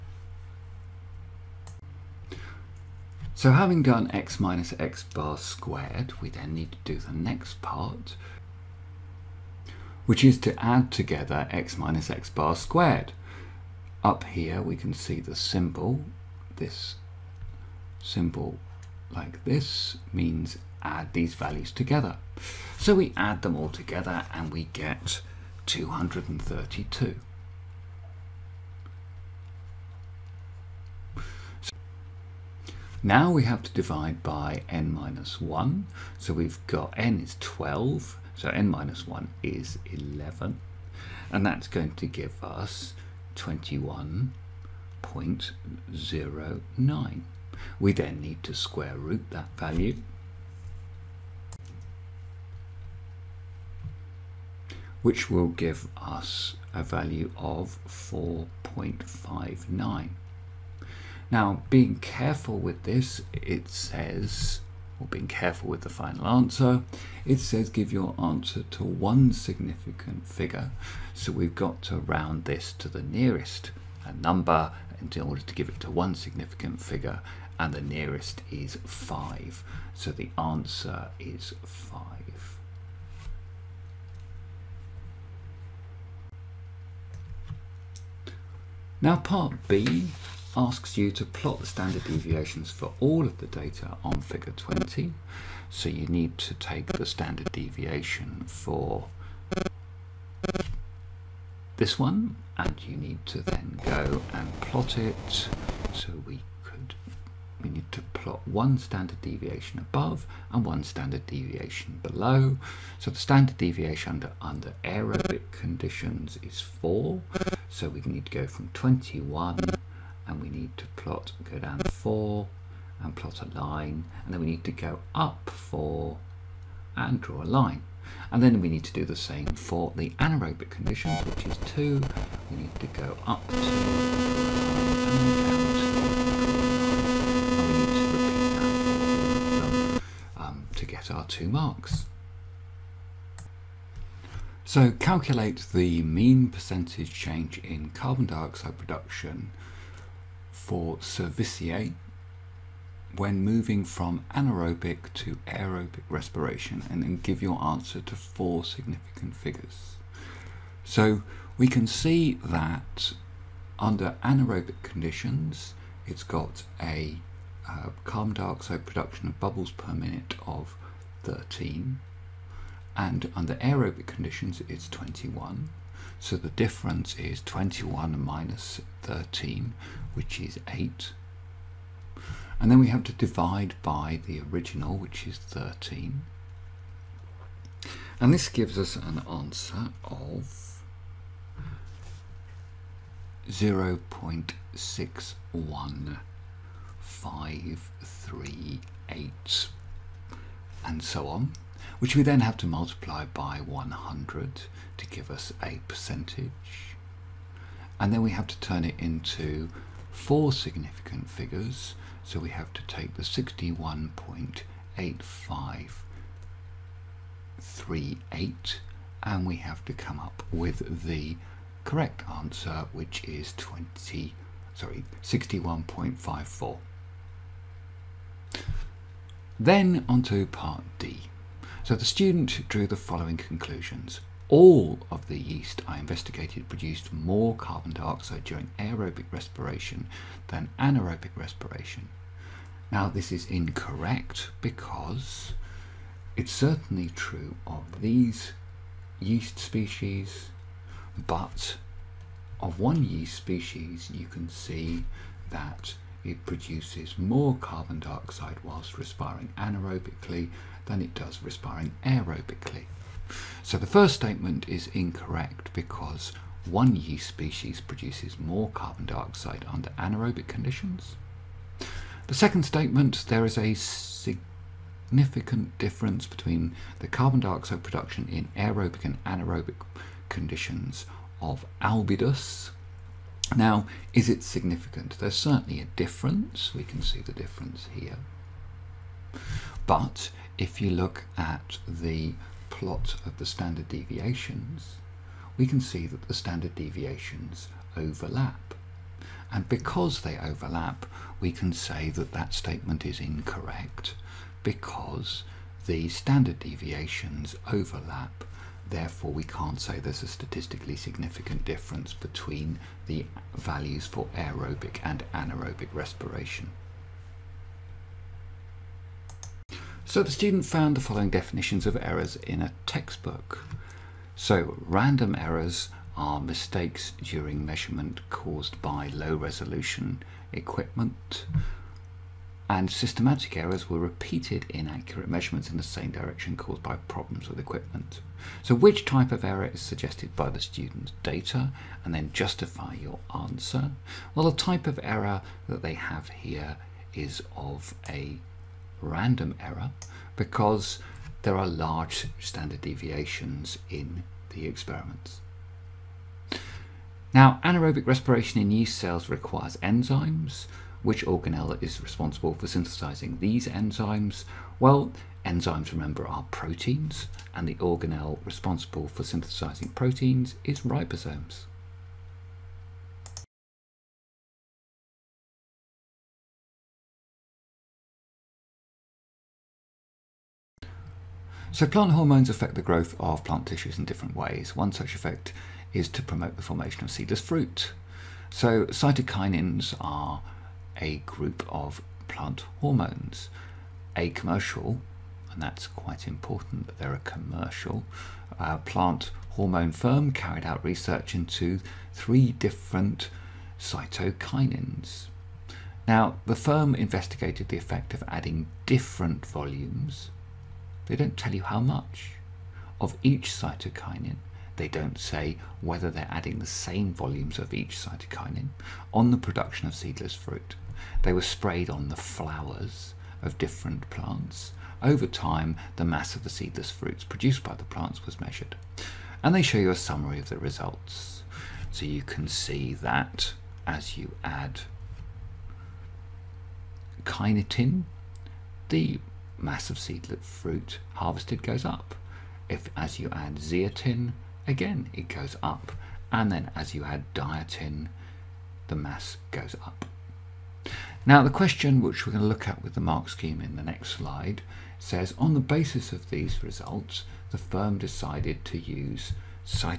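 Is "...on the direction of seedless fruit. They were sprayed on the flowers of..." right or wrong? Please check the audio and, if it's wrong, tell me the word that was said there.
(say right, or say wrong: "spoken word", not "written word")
wrong: "production", not "direction".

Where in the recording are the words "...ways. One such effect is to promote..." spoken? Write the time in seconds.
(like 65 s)
384 s.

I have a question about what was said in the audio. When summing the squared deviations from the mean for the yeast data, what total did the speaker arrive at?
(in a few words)
232.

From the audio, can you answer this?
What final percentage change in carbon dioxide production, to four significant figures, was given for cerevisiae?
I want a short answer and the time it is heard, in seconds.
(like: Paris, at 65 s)
61.54, at 225 s.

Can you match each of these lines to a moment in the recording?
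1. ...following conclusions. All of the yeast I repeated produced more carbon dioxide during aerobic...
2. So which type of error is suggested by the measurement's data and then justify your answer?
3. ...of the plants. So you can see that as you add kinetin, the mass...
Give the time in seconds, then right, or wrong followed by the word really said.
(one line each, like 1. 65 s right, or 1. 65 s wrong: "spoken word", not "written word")
1. 232 s wrong: "investigated", not "repeated"
2. 338 s wrong: "student", not "measurement"
3. 430 s wrong: "results", not "plants".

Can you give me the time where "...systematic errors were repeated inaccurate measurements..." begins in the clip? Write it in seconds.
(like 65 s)
332 s.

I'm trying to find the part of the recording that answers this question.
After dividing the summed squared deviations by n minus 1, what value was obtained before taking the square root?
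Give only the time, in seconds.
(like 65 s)
43 s.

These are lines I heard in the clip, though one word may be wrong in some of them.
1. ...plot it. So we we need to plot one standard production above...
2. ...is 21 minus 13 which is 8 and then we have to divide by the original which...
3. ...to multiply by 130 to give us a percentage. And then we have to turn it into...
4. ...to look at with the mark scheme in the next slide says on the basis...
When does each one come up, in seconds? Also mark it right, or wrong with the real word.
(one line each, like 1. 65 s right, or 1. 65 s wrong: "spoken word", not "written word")
1. 104 s wrong: "deviation", not "production"
2. 177 s right
3. 202 s wrong: "100", not "130"
4. 452 s right.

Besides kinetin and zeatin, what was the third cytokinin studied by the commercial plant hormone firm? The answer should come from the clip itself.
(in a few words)
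diatin.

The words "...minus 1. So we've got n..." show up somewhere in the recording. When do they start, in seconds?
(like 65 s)
34 s.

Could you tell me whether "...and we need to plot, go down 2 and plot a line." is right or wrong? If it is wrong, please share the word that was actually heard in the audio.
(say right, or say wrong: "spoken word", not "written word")
wrong: "4", not "2".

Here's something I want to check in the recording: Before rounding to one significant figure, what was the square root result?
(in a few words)
4.59.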